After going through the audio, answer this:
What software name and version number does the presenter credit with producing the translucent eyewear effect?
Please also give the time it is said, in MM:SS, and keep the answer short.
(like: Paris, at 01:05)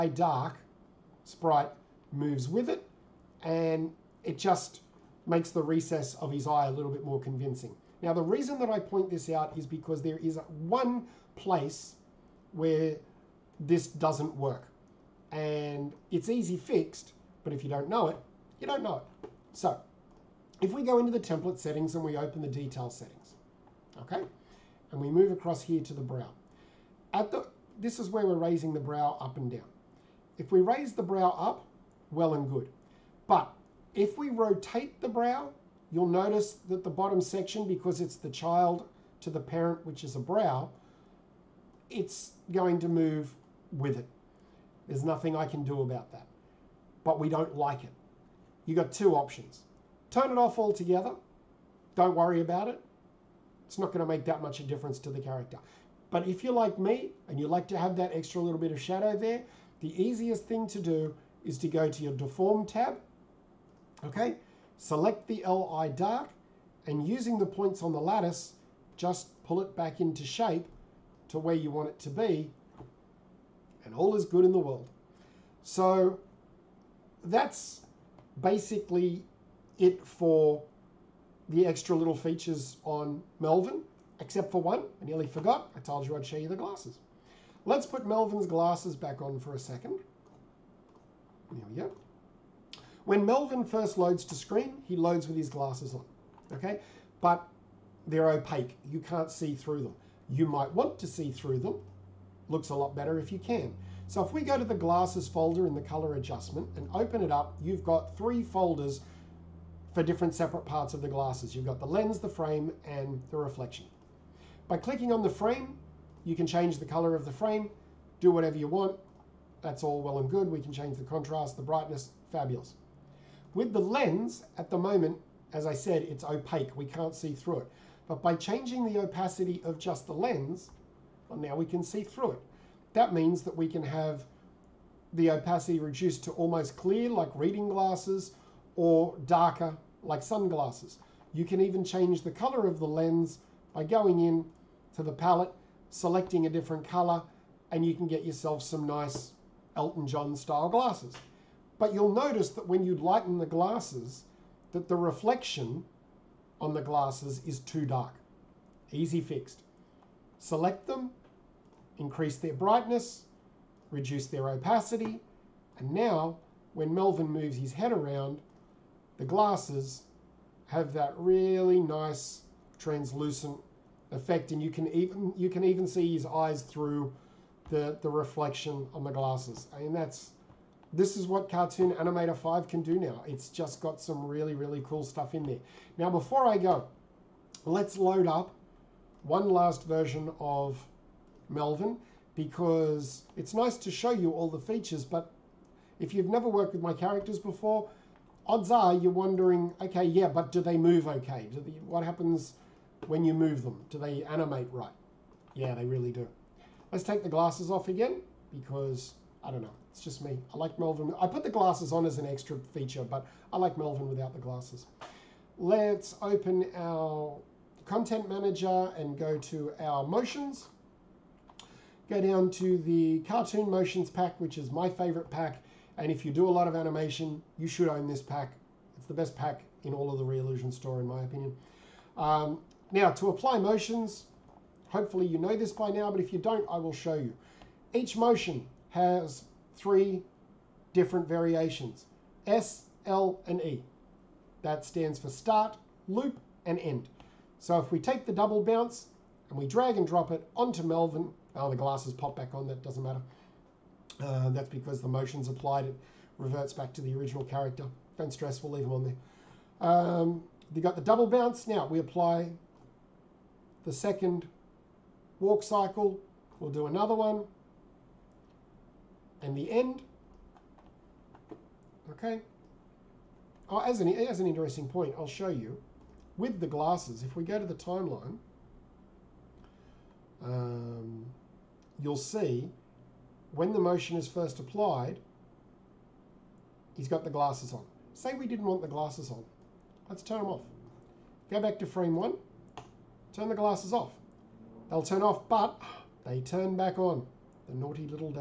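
Cartoon Animator 5, at 03:01.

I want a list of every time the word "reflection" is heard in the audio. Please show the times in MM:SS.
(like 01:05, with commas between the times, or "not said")
01:53, 02:34, 02:58.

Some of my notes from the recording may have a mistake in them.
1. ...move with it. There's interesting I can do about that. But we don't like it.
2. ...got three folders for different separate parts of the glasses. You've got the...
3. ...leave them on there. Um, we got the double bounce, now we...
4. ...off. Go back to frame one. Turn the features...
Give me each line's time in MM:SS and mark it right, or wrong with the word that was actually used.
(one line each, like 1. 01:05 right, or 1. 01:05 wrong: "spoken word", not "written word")
1. 00:42 wrong: "nothing", not "interesting"
2. 01:47 right
3. 04:18 right
4. 04:50 wrong: "glasses", not "features".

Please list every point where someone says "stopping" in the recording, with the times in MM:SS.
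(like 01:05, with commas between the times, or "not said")
not said.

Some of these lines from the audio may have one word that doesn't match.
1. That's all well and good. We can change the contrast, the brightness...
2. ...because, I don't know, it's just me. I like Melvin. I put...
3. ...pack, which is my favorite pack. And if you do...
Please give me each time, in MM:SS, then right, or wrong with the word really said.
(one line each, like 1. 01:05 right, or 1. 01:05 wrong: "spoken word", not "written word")
1. 01:59 right
2. 03:28 right
3. 03:44 right.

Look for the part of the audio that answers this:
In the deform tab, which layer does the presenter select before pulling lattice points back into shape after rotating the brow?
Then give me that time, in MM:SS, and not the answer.
01:05.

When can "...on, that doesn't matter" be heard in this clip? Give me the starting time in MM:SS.
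04:12.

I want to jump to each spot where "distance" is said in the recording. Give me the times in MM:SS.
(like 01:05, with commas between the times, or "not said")
not said.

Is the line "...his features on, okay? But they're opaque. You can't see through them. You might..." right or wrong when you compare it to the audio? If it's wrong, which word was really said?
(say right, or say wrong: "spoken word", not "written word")
wrong: "glasses", not "features".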